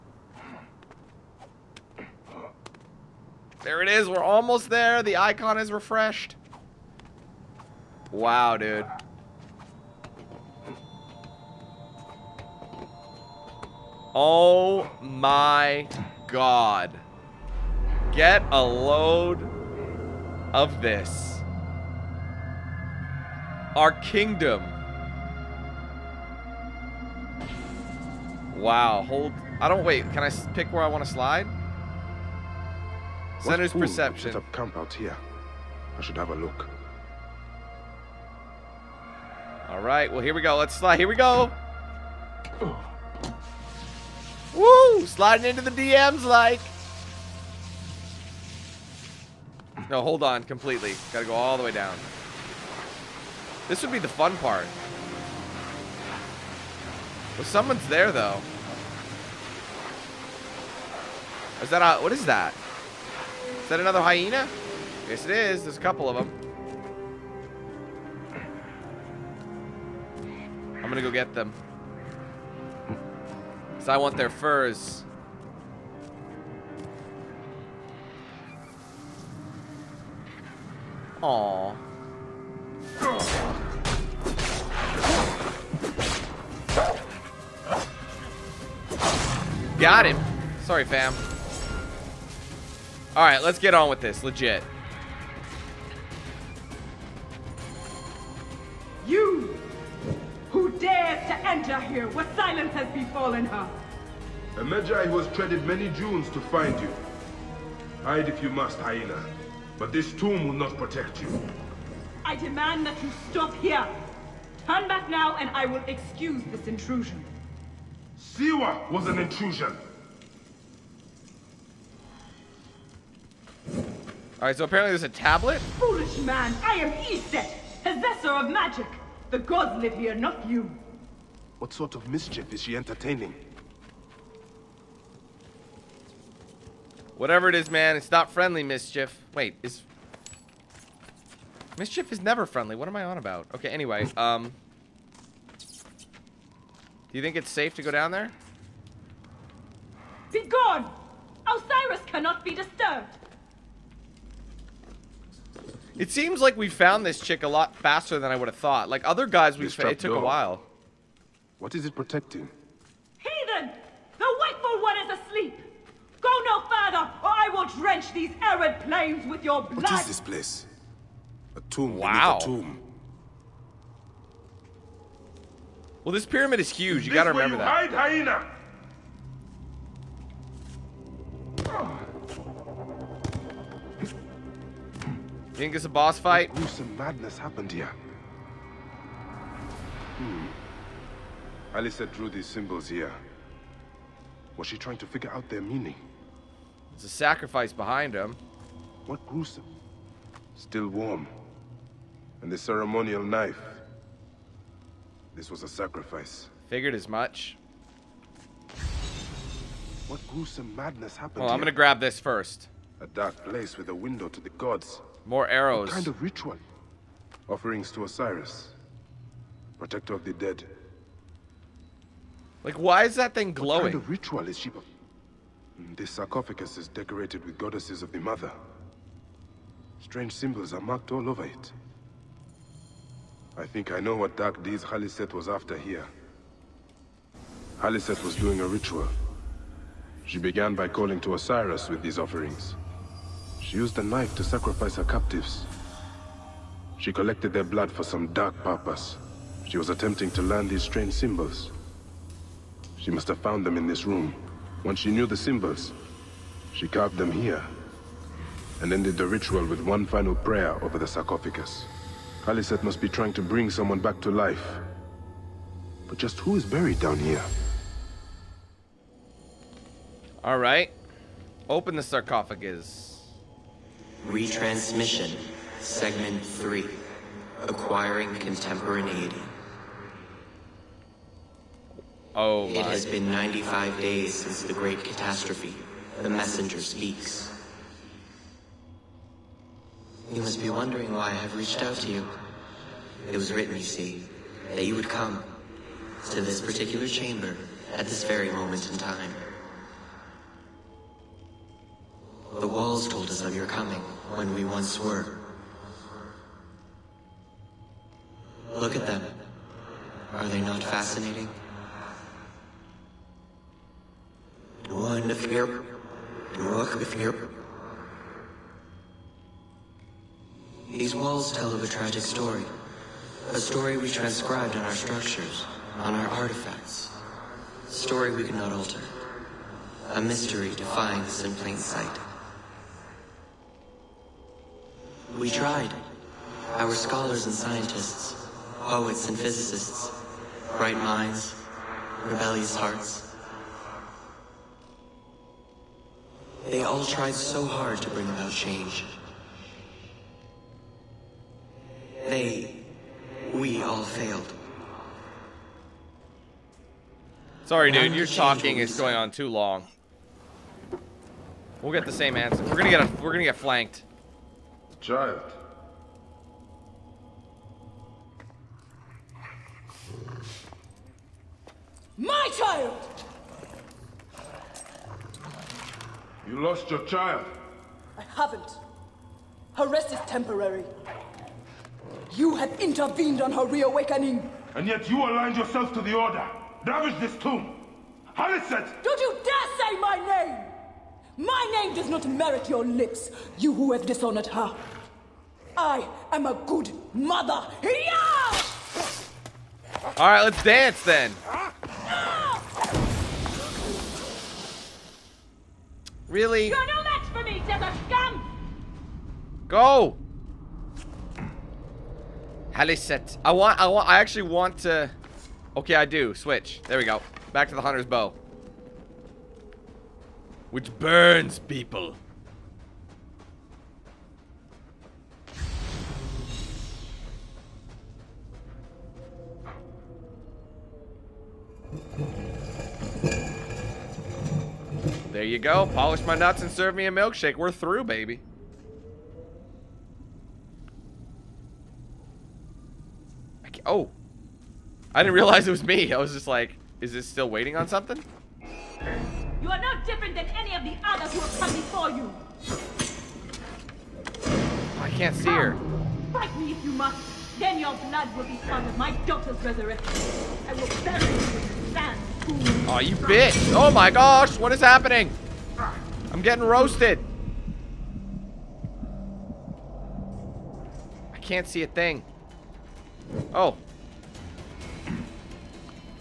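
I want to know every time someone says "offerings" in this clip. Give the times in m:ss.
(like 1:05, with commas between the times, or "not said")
3:37, 4:02.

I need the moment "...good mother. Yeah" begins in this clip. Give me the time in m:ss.
6:36.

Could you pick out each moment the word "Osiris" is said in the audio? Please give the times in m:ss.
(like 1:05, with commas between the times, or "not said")
2:31, 3:38, 4:01.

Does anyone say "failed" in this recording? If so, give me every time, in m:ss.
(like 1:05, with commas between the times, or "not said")
5:54.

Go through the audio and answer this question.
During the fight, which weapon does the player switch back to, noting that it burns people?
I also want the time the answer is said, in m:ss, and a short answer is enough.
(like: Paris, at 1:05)
Hunter's bow, at 6:57.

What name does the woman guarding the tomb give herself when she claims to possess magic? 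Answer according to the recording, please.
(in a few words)
Iset.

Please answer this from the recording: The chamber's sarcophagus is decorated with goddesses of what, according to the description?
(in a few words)
The mother.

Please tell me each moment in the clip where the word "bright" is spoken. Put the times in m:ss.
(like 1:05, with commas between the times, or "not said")
5:40.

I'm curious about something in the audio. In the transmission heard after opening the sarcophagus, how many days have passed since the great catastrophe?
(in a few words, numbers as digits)
95.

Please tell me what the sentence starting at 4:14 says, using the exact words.
Once she knew the symbols, she carved them here.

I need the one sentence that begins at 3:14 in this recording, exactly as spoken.
Was she trying to figure out their meaning?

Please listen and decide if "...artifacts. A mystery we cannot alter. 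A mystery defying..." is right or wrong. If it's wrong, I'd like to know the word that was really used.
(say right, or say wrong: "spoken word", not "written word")
wrong: "story", not "mystery".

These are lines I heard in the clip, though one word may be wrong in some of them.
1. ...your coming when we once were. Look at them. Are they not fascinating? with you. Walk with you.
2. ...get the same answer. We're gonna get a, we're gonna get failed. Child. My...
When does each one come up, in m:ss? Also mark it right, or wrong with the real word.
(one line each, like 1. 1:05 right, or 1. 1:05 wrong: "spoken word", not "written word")
1. 5:03 right
2. 6:01 wrong: "flanked", not "failed".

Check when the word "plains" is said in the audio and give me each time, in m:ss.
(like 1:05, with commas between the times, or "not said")
2:48, 5:31.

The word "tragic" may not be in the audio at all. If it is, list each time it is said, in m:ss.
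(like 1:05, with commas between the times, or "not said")
5:21.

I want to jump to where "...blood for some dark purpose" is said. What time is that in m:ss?
4:07.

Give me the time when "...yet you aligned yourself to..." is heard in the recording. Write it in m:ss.
6:24.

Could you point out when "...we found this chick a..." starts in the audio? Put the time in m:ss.
2:36.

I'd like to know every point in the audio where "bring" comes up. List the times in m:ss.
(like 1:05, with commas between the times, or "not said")
4:23, 5:48.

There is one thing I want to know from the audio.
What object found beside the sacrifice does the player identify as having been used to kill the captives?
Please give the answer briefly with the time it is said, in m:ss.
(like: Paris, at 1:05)
Ceremonial knife, at 3:22.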